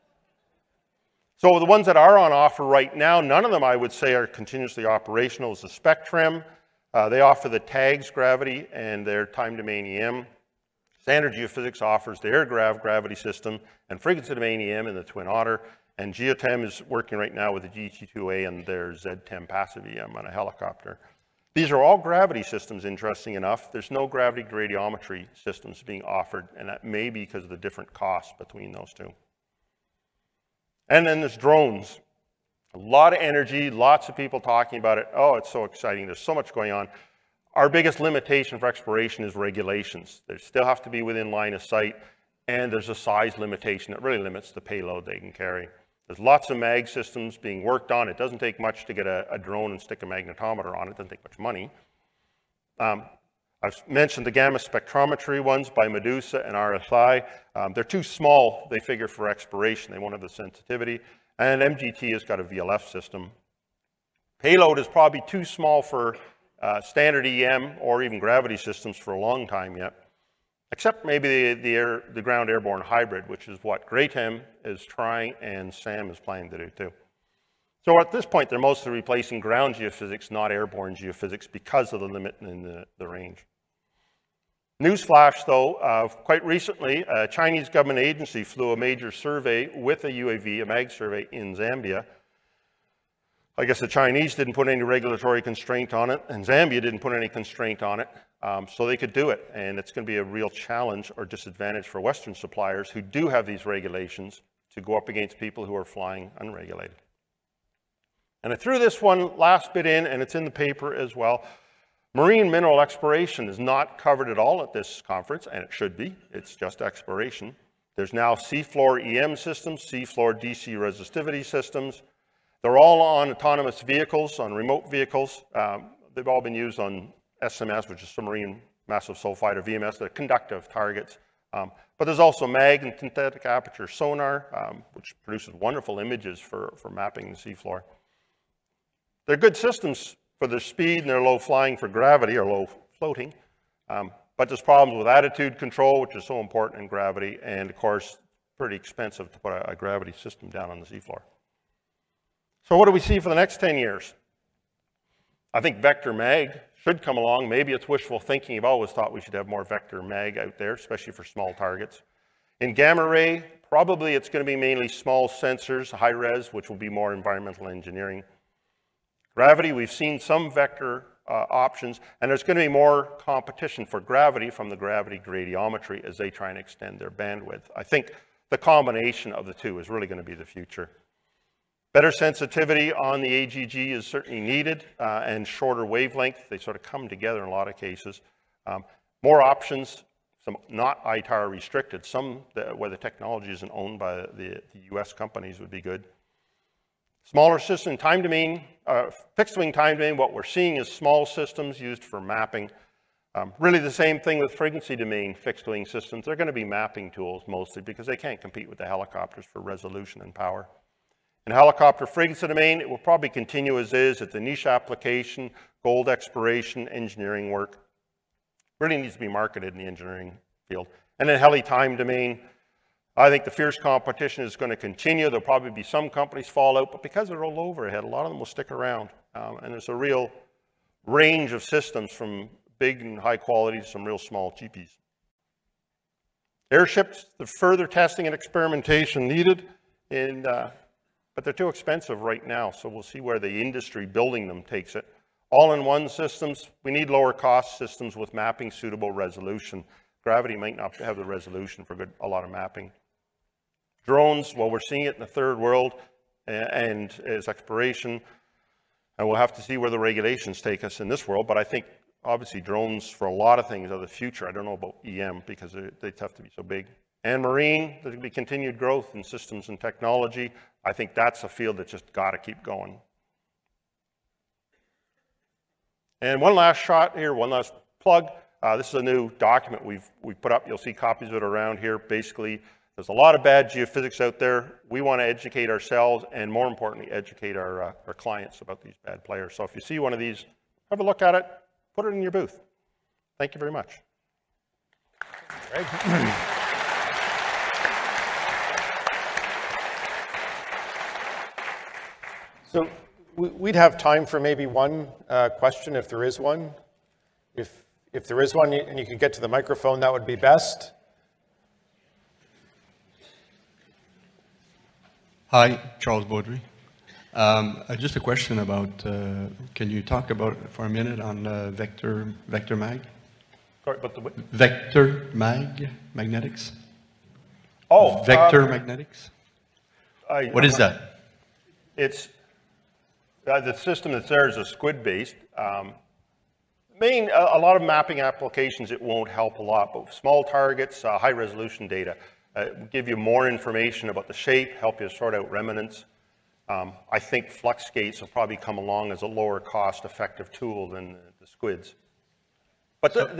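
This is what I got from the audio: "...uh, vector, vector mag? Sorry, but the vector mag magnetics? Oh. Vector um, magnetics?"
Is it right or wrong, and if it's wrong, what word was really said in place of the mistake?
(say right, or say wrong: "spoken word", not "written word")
right.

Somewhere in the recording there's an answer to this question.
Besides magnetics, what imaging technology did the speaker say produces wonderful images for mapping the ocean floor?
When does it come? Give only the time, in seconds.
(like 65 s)
132 s.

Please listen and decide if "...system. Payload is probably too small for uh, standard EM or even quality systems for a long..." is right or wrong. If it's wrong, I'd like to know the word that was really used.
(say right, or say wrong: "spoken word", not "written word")
wrong: "gravity", not "quality".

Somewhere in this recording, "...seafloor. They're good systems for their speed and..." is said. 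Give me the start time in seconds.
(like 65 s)
137 s.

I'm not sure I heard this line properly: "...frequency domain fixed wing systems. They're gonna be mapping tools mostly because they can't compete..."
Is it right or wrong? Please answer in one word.
right.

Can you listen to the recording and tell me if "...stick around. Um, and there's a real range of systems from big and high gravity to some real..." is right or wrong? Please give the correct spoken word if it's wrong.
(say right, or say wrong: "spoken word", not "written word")
wrong: "quality", not "gravity".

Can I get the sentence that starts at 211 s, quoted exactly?
In helicopter frequency domain, it will probably continue as is at the niche application, gold exploration, engineering work.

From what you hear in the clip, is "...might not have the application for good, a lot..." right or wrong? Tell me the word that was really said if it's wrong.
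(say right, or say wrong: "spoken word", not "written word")
wrong: "resolution", not "application".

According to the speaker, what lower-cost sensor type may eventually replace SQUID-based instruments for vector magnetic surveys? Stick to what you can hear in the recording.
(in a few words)
flux gates.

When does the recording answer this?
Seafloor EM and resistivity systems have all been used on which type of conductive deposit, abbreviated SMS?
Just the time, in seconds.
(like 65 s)
128 s.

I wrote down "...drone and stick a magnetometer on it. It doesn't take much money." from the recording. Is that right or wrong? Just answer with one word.
right.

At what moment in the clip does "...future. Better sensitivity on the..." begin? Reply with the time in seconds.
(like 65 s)
180 s.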